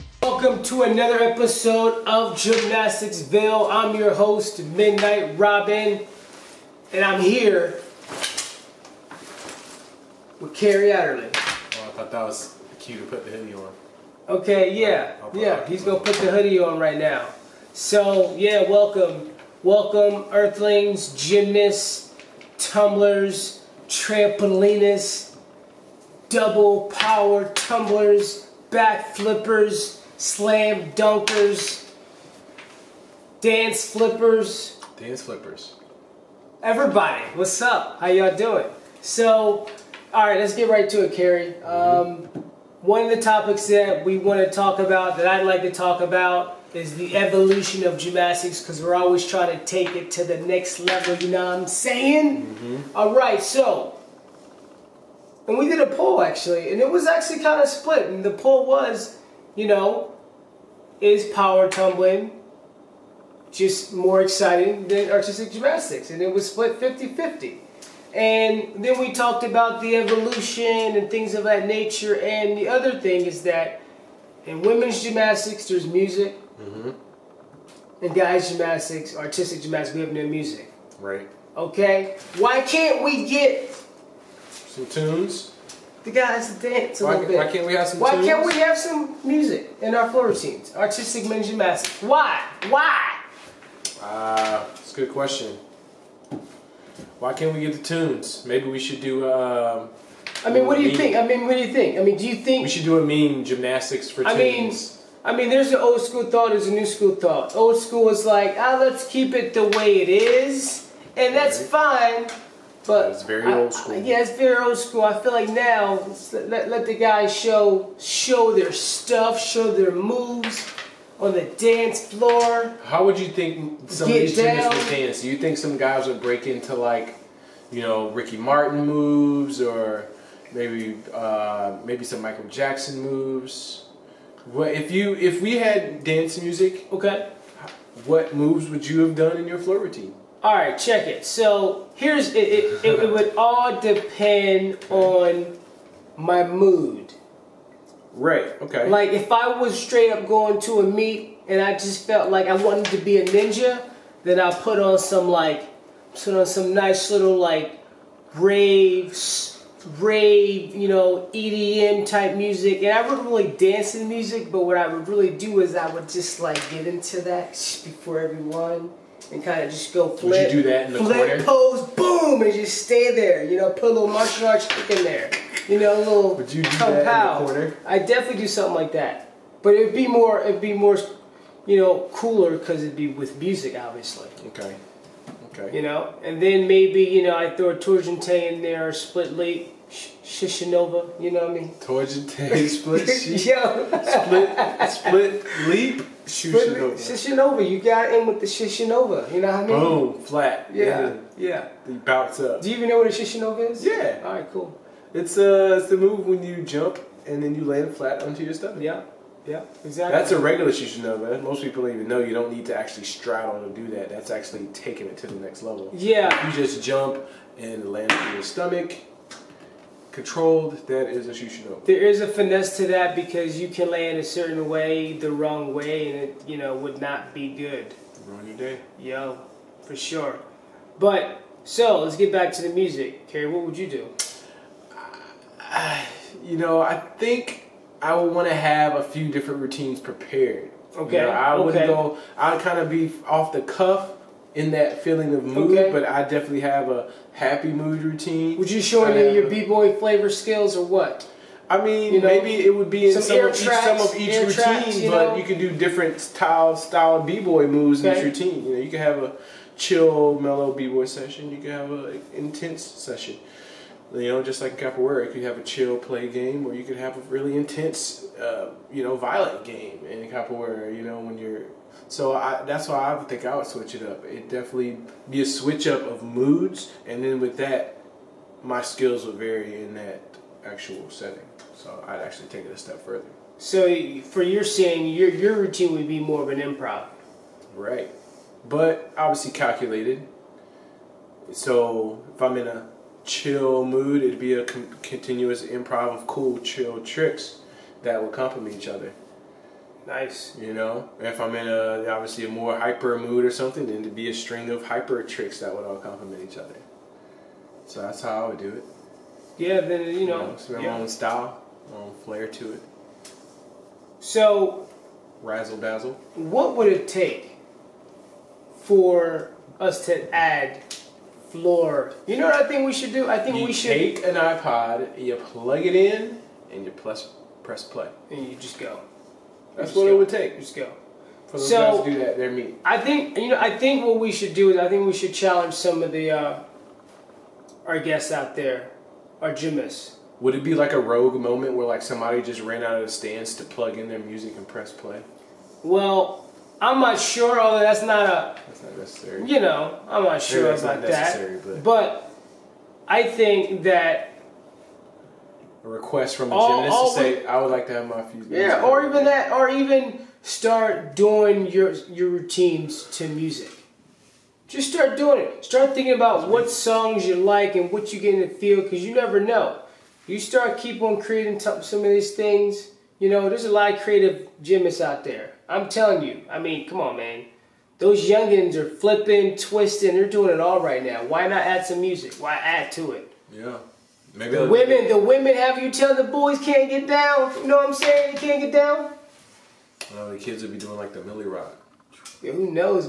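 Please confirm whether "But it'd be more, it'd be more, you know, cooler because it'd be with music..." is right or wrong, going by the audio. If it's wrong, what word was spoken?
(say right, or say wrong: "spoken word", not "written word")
right.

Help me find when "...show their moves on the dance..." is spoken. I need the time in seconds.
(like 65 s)
119 s.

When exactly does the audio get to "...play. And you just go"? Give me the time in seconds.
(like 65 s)
327 s.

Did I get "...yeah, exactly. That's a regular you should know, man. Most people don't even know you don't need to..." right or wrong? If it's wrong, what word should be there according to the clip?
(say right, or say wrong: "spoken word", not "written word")
right.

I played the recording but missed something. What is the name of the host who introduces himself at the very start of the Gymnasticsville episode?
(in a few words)
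Midknight Robin.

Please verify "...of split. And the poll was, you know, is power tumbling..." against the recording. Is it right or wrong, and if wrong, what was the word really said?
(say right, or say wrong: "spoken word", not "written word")
right.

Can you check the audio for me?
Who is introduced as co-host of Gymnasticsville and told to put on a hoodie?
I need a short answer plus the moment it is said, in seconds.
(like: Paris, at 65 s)
Kerry Adderly, at 10 s.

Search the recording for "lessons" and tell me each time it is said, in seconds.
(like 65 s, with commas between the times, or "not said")
not said.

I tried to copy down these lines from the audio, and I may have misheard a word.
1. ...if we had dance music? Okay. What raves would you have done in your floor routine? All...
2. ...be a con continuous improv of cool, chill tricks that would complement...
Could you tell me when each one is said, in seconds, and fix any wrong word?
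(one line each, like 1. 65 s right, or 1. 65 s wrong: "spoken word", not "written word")
1. 135 s wrong: "moves", not "raves"
2. 294 s right.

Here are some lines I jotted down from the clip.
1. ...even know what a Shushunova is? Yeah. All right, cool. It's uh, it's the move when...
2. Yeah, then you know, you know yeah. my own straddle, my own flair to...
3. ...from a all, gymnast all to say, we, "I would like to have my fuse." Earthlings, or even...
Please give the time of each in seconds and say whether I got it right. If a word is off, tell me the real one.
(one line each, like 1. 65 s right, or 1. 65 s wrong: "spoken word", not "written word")
1. 202 s right
2. 309 s wrong: "style", not "straddle"
3. 356 s wrong: "Yeah", not "Earthlings".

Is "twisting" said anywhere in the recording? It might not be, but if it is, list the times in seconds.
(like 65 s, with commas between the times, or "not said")
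379 s.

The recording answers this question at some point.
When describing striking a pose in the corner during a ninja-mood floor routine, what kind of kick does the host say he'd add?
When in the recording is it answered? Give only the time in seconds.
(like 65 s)
174 s.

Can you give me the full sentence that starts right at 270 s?
You know, when you're so I, that's why I would think I would switch it up.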